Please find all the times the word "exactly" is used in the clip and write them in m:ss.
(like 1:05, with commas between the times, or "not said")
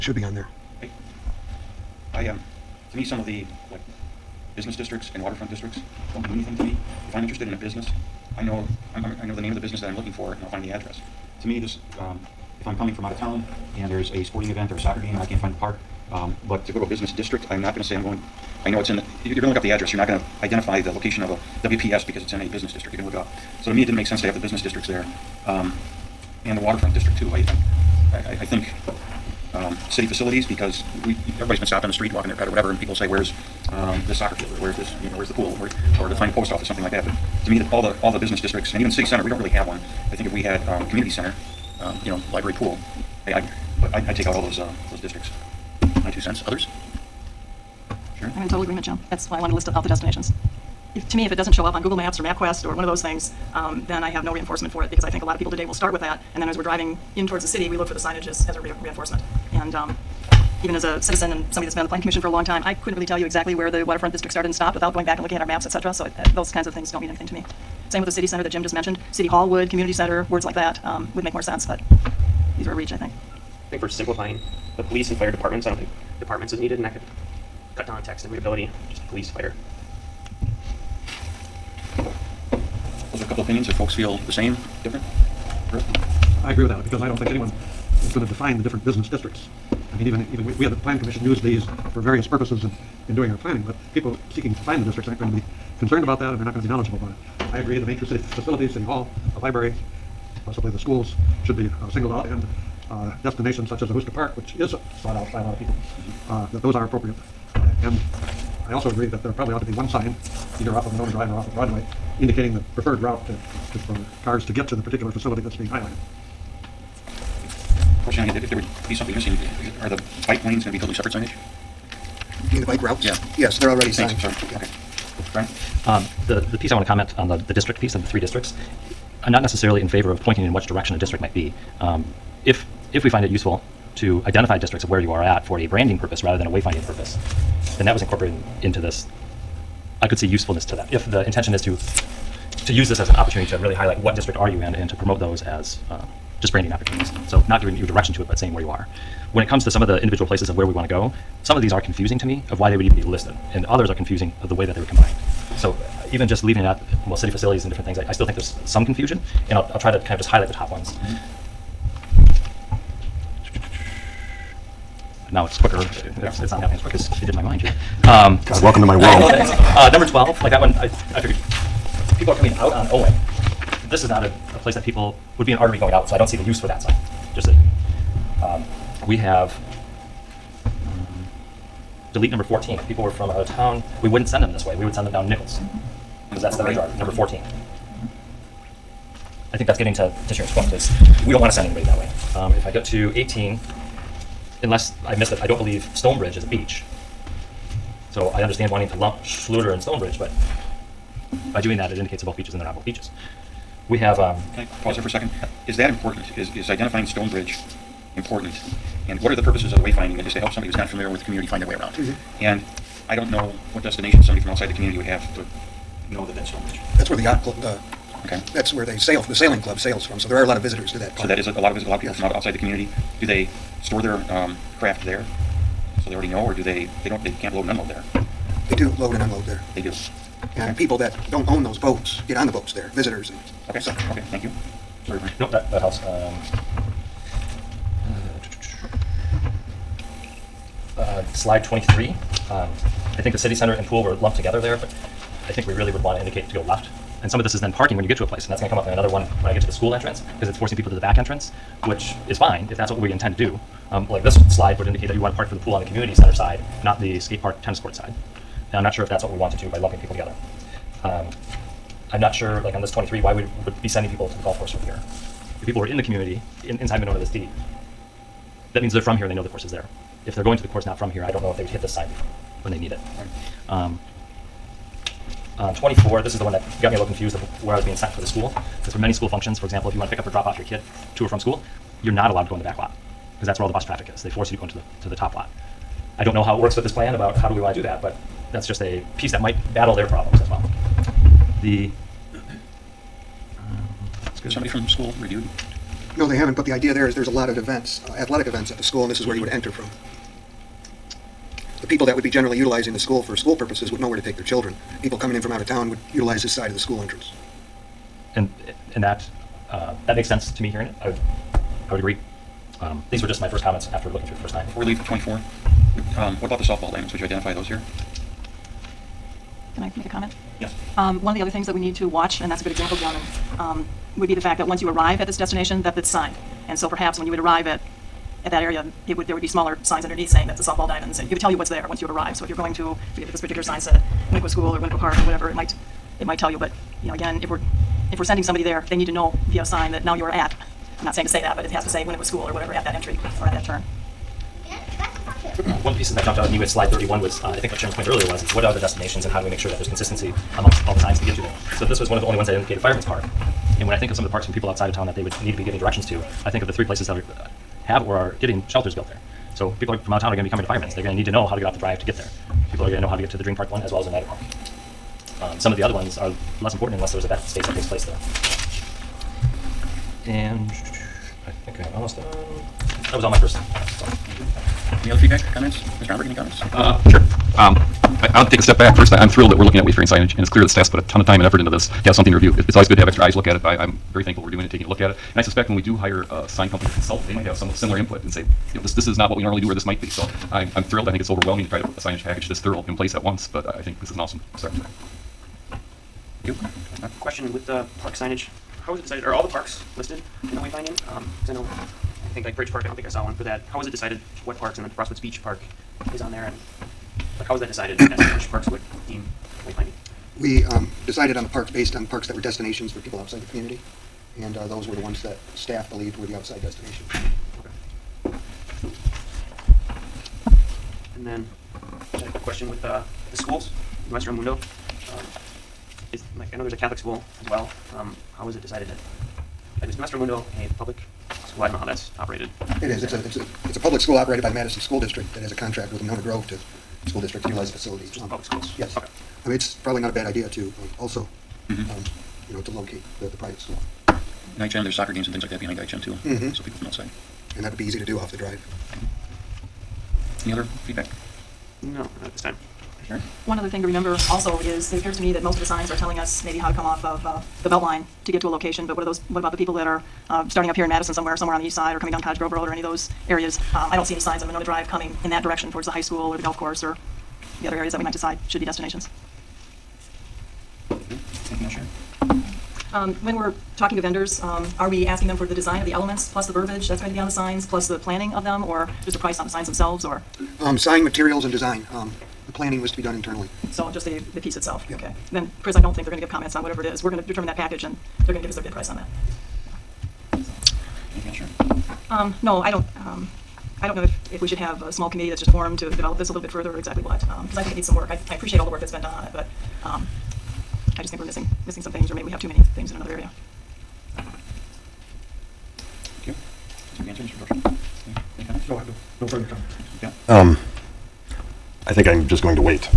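1:03, 8:16.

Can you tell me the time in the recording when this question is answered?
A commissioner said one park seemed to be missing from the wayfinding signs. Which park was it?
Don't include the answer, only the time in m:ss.
6:42.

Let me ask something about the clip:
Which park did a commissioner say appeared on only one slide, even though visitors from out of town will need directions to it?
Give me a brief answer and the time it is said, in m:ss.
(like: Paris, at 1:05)
Fireman's Park, at 5:52.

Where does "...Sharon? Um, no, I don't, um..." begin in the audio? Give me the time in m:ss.
8:11.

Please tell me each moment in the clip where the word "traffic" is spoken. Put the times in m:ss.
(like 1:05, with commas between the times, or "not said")
4:43.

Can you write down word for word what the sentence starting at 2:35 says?
So even just leaving it out, well, city facilities and different things, I, I still think there's some confusion.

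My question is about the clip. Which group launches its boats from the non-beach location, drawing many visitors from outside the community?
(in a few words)
the sailing club.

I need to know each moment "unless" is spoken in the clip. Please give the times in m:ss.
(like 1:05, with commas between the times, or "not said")
3:14, 6:06.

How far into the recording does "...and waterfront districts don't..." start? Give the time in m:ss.
0:05.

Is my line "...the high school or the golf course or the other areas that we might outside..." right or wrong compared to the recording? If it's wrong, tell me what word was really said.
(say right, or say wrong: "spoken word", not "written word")
wrong: "decide", not "outside".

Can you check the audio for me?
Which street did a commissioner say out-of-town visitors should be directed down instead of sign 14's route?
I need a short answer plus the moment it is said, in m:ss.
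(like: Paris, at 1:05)
Nichols, at 3:05.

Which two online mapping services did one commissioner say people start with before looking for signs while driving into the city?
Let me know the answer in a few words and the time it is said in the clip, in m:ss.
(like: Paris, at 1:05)
Google Maps or MapQuest, at 0:51.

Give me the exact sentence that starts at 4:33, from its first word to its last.
Um, um, 24, this is the one that got me a little confused of where I was being sent for the school.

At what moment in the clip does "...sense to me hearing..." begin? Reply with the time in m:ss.
5:10.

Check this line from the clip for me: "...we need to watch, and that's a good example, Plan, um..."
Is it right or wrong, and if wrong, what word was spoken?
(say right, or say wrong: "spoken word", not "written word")
wrong: "John", not "Plan".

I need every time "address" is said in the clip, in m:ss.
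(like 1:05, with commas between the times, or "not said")
0:10, 0:19.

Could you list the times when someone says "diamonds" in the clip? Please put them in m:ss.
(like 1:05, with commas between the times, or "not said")
5:16, 5:30.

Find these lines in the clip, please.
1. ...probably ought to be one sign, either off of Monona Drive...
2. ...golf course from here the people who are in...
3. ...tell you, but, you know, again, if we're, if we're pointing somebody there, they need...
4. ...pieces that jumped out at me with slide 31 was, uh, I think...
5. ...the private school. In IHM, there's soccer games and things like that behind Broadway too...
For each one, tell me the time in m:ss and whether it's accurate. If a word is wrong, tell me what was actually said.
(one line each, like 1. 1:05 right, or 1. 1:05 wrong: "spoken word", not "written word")
1. 1:49 right
2. 4:24 right
3. 5:36 wrong: "sending", not "pointing"
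4. 5:45 right
5. 7:23 wrong: "IHM", not "Broadway".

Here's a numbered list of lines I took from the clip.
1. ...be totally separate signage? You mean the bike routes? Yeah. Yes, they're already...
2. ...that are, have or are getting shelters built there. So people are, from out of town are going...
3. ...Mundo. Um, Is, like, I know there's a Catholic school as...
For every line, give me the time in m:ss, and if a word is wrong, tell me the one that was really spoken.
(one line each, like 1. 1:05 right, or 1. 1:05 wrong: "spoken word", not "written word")
1. 2:00 right
2. 5:57 right
3. 7:04 right.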